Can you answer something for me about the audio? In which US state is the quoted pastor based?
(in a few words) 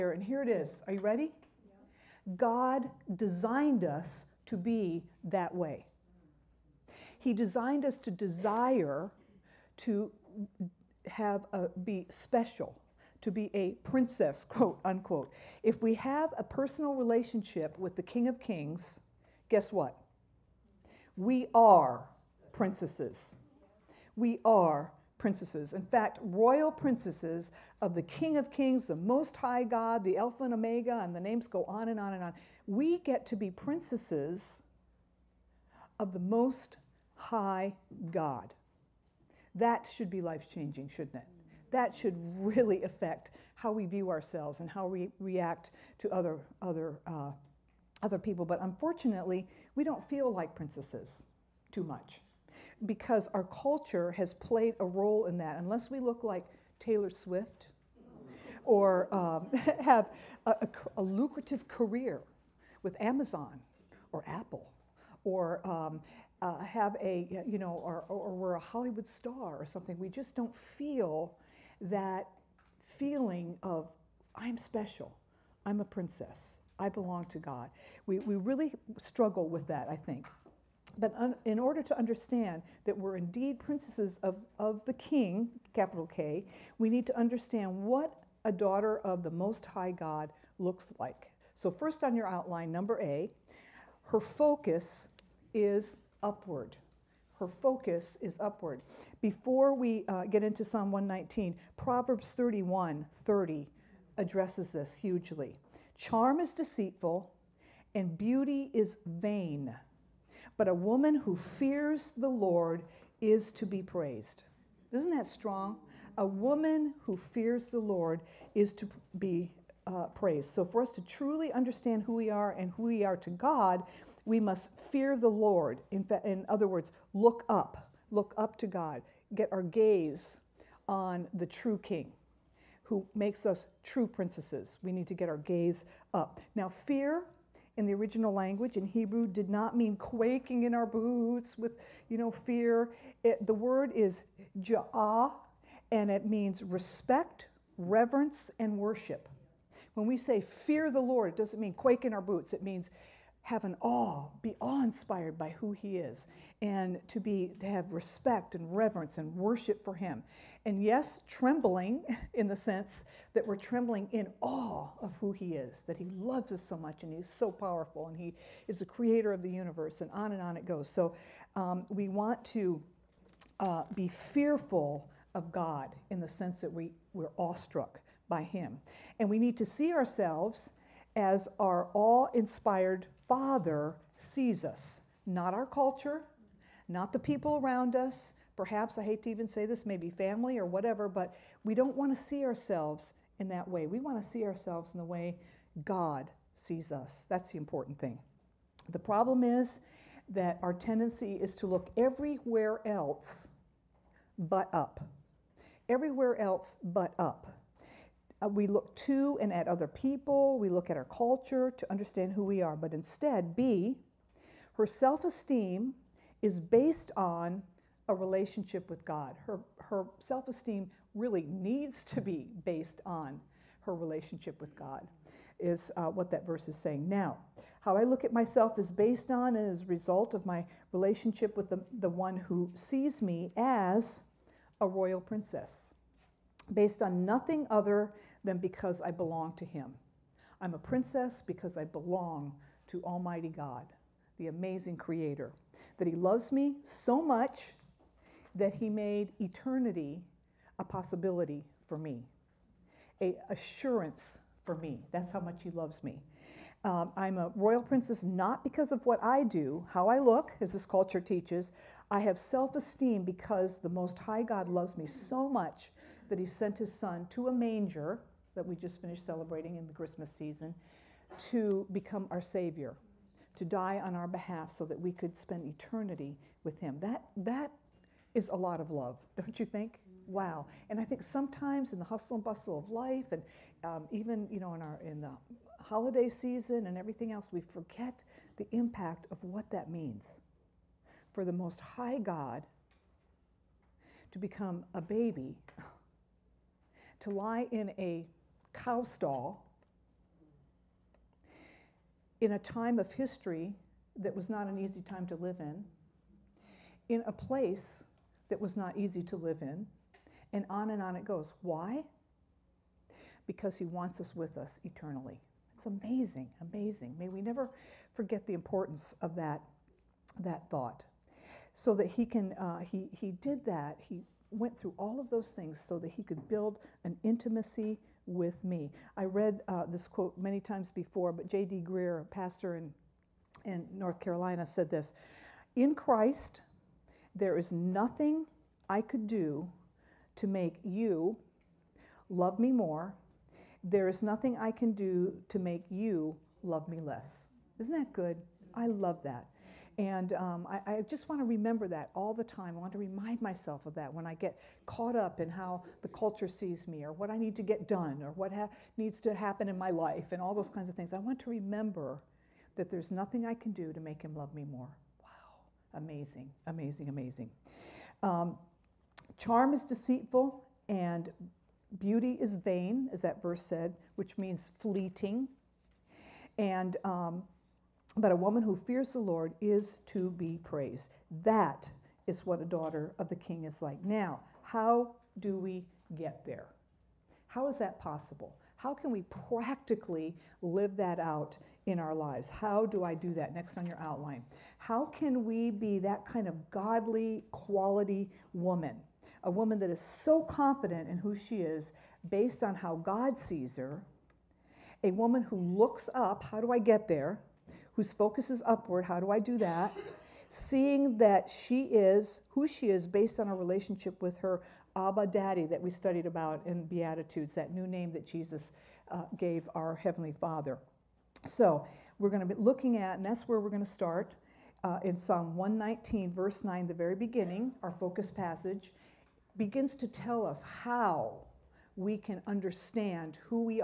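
North Carolina.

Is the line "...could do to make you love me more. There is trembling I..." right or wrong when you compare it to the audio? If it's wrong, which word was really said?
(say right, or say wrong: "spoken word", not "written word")
wrong: "nothing", not "trembling".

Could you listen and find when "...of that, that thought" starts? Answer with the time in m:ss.
5:19.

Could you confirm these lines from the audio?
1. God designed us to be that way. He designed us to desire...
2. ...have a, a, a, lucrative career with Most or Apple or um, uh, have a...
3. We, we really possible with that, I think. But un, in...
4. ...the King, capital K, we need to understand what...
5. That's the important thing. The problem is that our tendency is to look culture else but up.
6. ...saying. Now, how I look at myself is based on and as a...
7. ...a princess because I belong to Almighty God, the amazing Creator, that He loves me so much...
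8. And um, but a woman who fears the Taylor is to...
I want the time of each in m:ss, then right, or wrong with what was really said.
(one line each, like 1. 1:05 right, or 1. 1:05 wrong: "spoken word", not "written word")
1. 0:02 right
2. 0:59 wrong: "Amazon", not "Most"
3. 1:18 wrong: "struggle", not "possible"
4. 1:24 right
5. 3:17 wrong: "everywhere", not "culture"
6. 3:46 right
7. 4:00 right
8. 6:16 wrong: "Lord", not "Taylor".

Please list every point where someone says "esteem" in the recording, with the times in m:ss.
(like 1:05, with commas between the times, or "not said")
3:35, 3:40, 4:22.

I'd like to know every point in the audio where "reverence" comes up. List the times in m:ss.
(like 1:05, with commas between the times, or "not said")
2:27, 2:38.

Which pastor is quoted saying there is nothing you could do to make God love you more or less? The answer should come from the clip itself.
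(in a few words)
J.D. Greear.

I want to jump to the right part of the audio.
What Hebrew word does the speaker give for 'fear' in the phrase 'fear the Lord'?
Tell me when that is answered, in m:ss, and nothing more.
2:24.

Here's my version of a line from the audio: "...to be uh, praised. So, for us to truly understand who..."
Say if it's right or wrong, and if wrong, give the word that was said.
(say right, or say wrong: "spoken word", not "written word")
right.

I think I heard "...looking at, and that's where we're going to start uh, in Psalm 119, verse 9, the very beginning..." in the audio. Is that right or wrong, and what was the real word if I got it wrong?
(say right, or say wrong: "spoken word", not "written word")
right.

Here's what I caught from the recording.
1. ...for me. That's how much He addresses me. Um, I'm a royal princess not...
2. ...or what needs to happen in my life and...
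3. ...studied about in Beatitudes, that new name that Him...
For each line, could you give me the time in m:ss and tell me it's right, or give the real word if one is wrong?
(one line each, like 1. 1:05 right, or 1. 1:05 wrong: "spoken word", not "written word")
1. 4:14 wrong: "loves", not "addresses"
2. 5:58 right
3. 6:55 wrong: "Jesus", not "Him".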